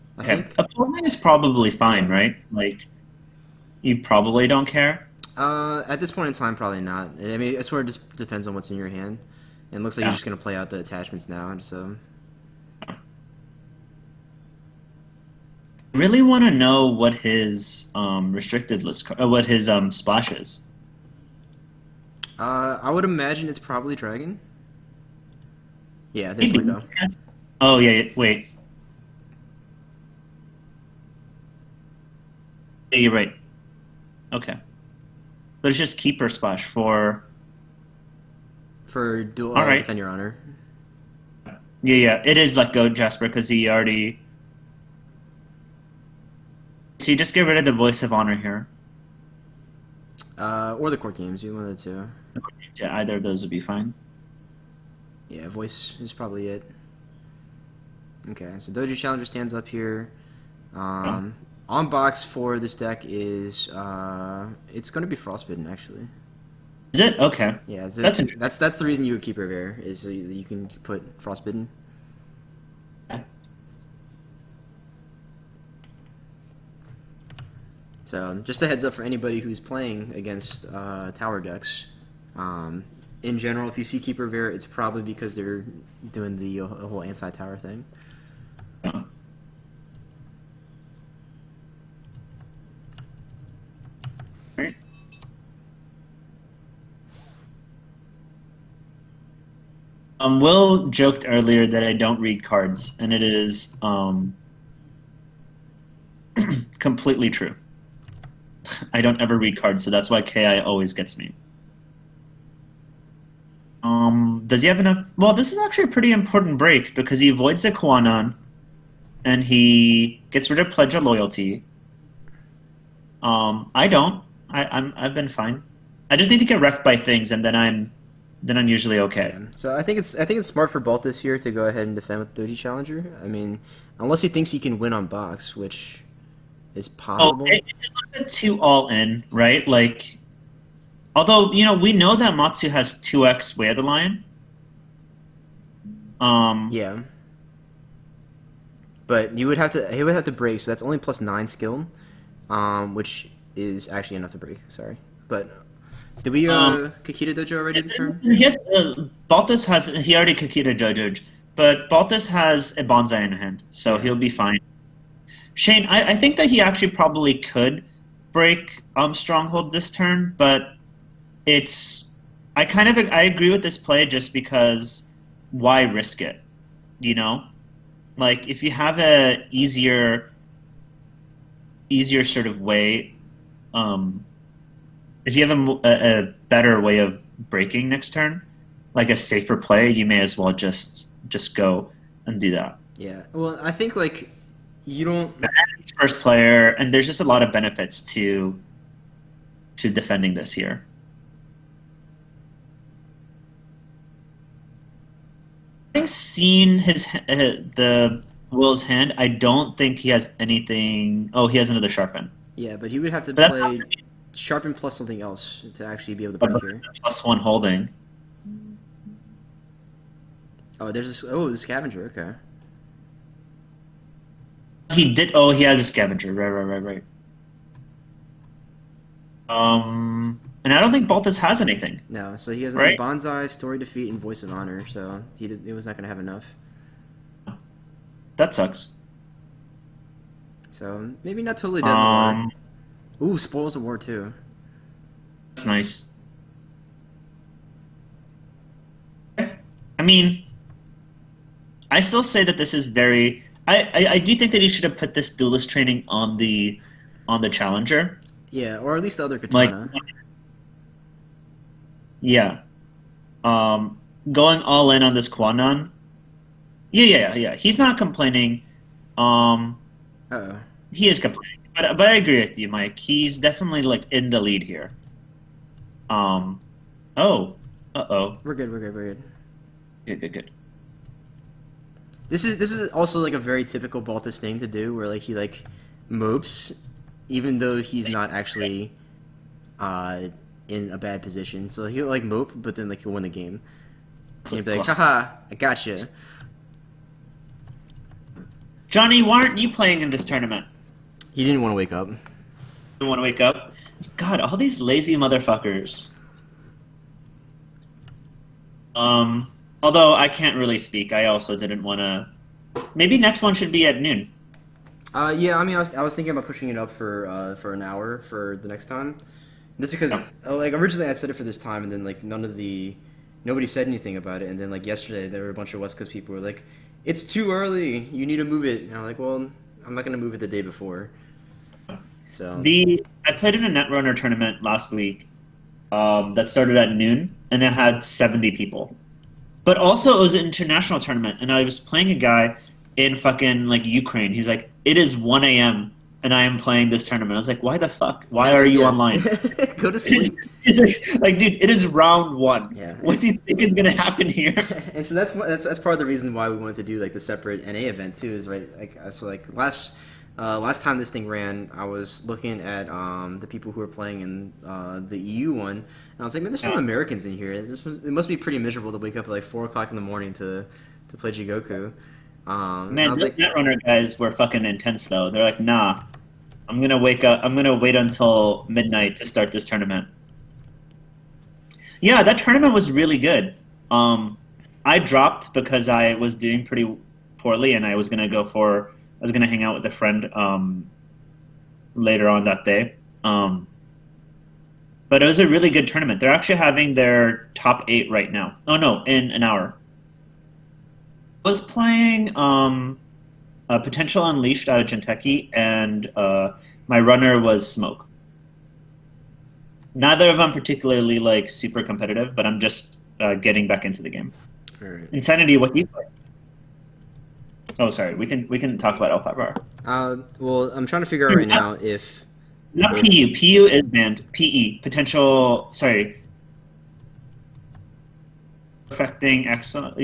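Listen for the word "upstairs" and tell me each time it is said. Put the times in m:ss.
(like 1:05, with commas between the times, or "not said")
not said.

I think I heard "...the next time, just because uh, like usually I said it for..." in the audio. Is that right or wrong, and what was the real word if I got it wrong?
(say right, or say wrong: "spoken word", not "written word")
wrong: "originally", not "usually".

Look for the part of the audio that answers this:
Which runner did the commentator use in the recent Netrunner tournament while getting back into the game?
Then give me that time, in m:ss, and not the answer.
6:47.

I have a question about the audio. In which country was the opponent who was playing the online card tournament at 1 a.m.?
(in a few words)
Ukraine.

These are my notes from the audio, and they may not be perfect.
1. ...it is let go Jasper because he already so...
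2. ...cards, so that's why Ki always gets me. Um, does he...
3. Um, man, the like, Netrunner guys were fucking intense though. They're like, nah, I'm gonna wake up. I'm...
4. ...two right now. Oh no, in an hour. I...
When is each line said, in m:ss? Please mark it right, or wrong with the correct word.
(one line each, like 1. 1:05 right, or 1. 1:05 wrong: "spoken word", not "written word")
1. 0:42 right
2. 1:49 right
3. 6:12 right
4. 6:37 wrong: "eight", not "two".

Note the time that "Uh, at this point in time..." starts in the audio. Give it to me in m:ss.
0:05.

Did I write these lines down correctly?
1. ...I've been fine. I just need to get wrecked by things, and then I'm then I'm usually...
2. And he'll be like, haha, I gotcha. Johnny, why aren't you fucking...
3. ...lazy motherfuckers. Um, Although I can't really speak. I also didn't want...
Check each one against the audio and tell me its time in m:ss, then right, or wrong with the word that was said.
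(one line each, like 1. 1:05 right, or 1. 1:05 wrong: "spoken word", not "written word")
1. 2:04 right
2. 4:54 wrong: "playing", not "fucking"
3. 5:04 right.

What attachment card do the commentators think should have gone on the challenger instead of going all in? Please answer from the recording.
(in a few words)
duelist training.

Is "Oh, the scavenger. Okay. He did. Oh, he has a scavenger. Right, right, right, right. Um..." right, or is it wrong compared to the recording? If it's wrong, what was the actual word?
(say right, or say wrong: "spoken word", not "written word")
right.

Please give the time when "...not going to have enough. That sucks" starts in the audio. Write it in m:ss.
3:55.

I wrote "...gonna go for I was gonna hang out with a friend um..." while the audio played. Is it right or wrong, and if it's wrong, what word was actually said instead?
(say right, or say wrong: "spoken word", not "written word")
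right.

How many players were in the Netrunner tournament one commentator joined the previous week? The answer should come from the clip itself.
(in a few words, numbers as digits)
70.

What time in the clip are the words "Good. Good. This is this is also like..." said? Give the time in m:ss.
4:40.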